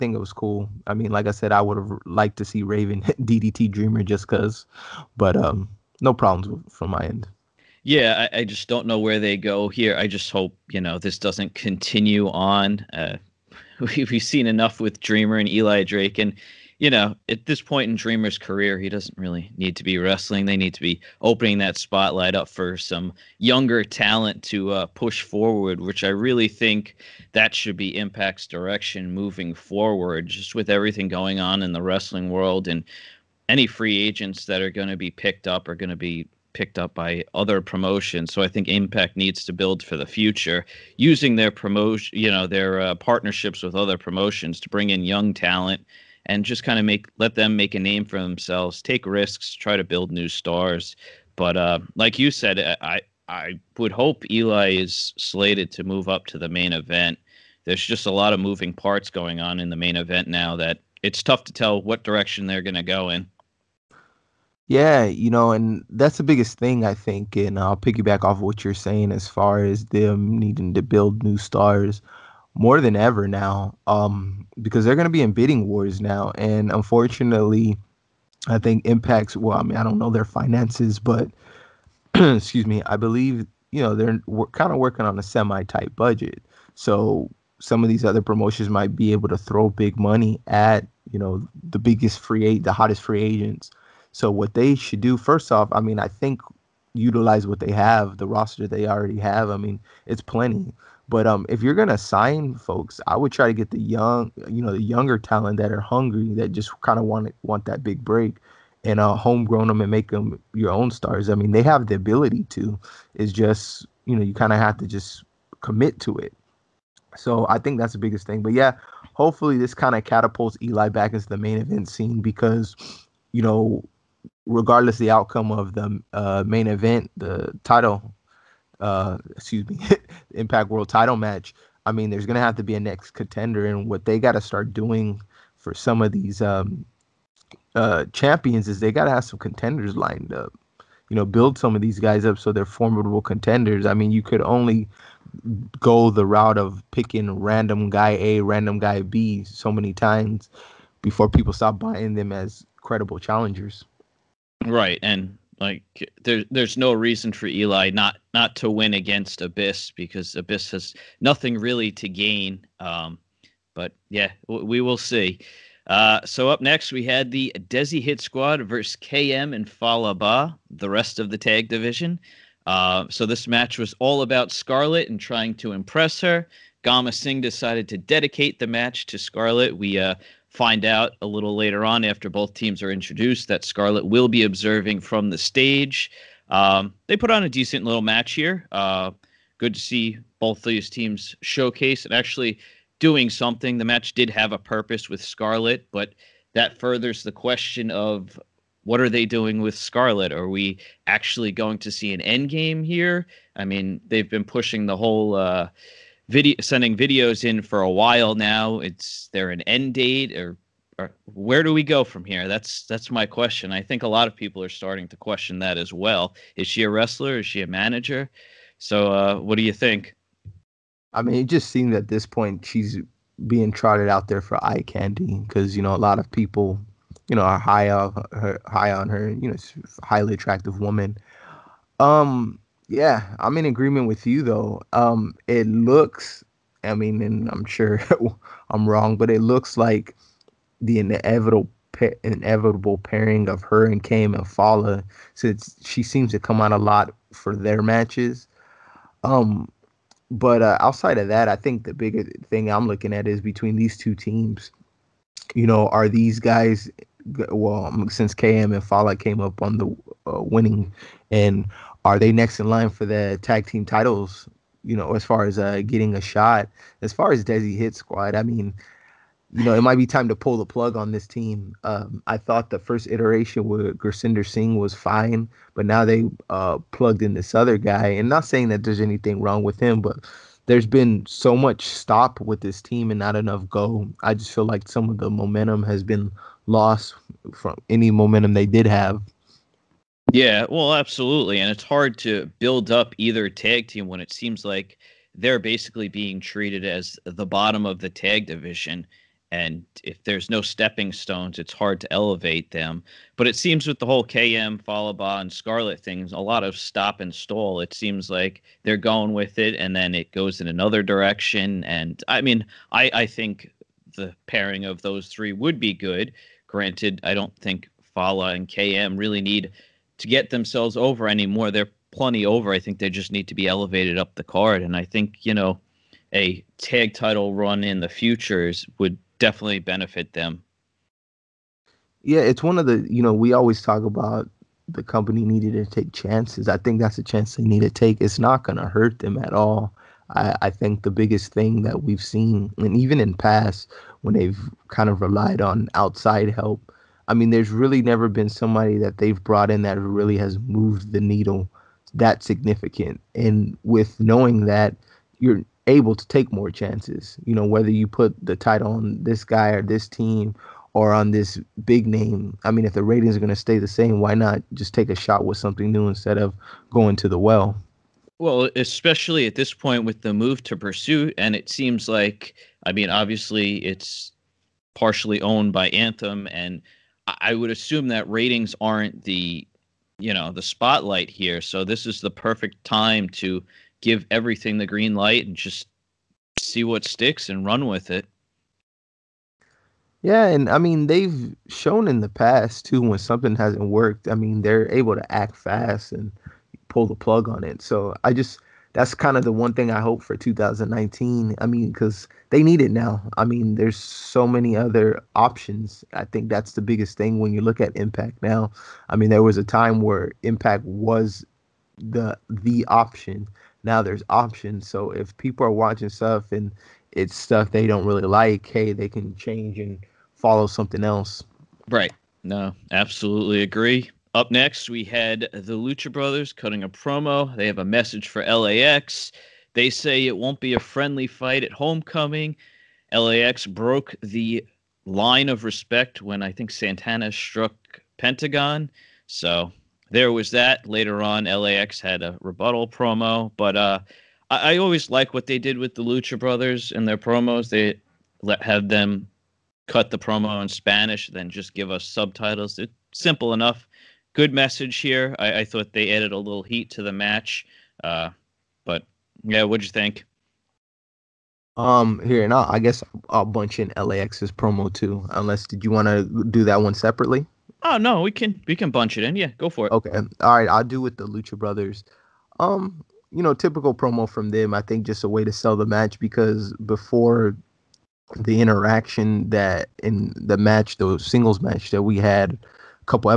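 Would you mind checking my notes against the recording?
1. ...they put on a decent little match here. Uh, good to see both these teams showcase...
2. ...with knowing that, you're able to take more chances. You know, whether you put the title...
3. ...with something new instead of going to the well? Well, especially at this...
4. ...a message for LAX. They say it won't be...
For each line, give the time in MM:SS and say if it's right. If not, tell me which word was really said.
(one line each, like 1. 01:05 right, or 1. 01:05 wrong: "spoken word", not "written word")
1. 03:07 right
2. 05:53 right
3. 06:05 right
4. 07:07 right.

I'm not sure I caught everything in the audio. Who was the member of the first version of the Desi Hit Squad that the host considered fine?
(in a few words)
Gursinder Singh.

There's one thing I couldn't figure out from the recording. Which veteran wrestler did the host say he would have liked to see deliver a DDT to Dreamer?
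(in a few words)
Raven.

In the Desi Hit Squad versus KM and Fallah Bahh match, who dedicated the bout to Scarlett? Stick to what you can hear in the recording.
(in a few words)
Gama Singh.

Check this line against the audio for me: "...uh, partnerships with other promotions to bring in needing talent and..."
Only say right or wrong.
wrong.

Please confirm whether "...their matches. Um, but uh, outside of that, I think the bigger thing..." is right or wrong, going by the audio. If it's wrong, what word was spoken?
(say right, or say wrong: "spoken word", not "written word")
right.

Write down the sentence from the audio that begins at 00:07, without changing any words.
Yeah, I, I, just don't know where they go here.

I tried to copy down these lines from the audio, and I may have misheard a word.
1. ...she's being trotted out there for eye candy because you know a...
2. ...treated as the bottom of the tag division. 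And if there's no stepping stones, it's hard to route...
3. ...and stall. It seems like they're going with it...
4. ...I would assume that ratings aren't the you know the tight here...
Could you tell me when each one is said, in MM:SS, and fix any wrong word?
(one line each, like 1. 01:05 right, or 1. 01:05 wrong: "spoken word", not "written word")
1. 03:42 right
2. 04:56 wrong: "elevate", not "route"
3. 05:07 right
4. 06:17 wrong: "spotlight", not "tight".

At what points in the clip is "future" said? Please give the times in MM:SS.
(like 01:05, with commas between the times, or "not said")
00:40, 05:28.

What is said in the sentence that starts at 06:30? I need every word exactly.
Yeah, and I mean they've shown in the past too when something hasn't worked.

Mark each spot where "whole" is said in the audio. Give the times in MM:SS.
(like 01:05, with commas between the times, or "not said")
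03:24, 05:04.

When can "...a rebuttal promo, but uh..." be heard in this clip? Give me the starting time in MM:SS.
07:22.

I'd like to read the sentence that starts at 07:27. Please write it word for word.
They let have them cut the promo in Spanish, then just give us subtitles.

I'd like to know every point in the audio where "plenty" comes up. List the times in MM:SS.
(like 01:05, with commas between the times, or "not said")
01:40, 05:22.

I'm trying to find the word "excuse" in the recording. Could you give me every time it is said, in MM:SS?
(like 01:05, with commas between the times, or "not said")
01:22, 02:09.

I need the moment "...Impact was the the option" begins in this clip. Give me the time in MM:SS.
06:50.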